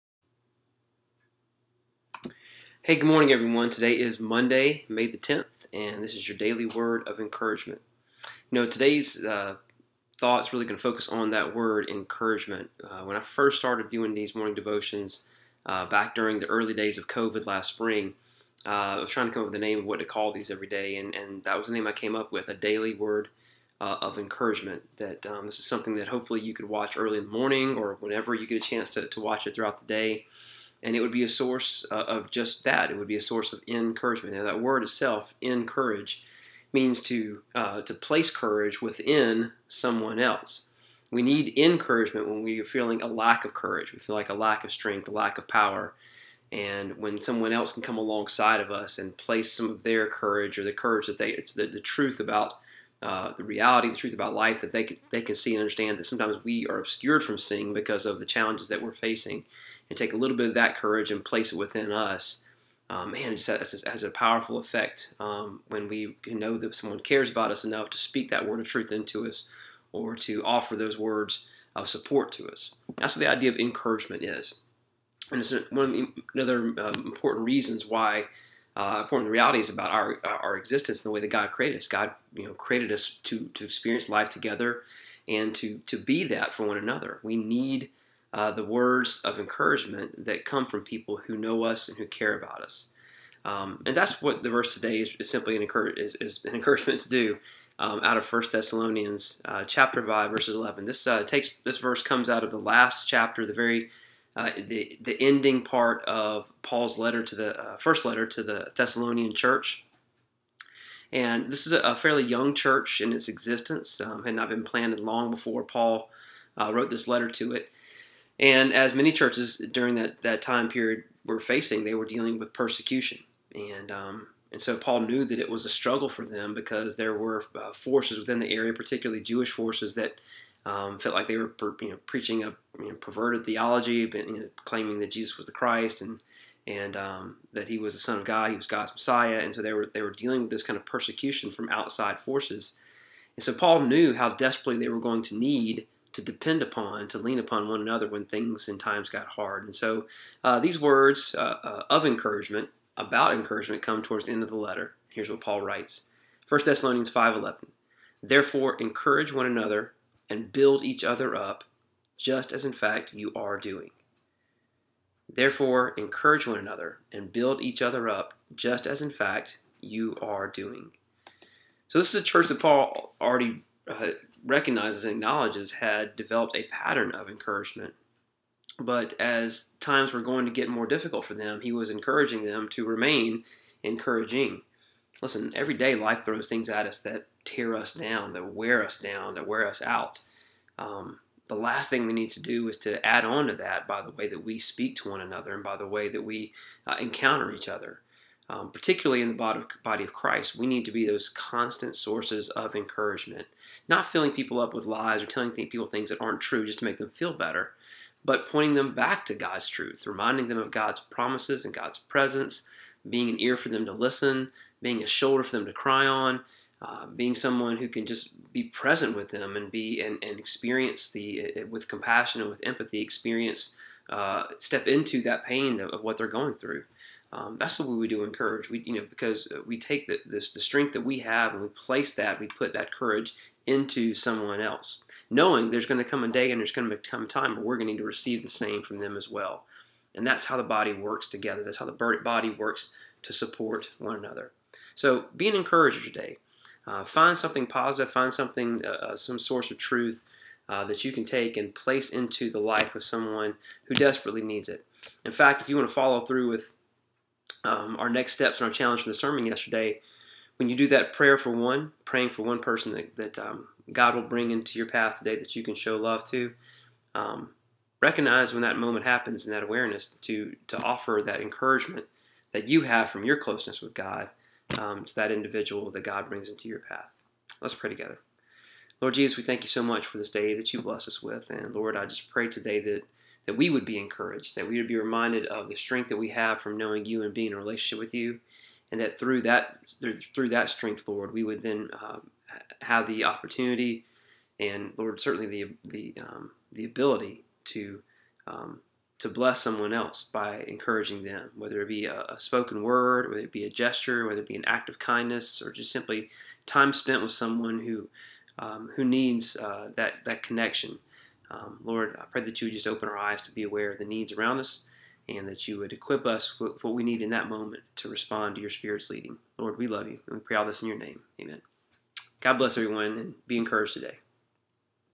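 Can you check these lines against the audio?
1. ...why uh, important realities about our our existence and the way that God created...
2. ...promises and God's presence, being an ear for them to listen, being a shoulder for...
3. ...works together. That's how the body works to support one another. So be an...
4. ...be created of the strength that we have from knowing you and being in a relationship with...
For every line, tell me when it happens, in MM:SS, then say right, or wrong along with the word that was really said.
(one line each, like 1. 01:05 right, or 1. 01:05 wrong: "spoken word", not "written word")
1. 01:17 right
2. 03:30 right
3. 04:00 right
4. 04:44 wrong: "reminded", not "created".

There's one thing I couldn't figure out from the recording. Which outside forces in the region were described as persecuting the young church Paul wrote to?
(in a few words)
Jewish forces.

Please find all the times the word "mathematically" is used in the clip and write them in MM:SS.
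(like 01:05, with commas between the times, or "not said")
not said.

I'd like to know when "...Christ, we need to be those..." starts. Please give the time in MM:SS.
03:20.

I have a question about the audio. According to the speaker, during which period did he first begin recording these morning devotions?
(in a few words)
early days of COVID.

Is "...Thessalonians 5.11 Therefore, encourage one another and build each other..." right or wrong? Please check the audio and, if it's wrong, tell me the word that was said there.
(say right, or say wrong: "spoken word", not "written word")
right.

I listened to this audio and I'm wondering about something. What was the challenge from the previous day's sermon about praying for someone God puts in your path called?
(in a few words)
prayer for one.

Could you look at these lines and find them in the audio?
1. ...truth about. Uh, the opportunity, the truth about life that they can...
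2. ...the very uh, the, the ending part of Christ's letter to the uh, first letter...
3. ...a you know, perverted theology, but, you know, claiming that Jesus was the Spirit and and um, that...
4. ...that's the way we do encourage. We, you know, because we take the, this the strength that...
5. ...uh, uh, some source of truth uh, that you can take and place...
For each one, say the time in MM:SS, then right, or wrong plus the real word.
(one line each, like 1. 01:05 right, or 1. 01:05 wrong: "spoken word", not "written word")
1. 00:51 wrong: "reality", not "opportunity"
2. 01:43 wrong: "Paul", not "Christ"
3. 02:12 wrong: "Christ", not "Spirit"
4. 03:47 right
5. 04:08 right.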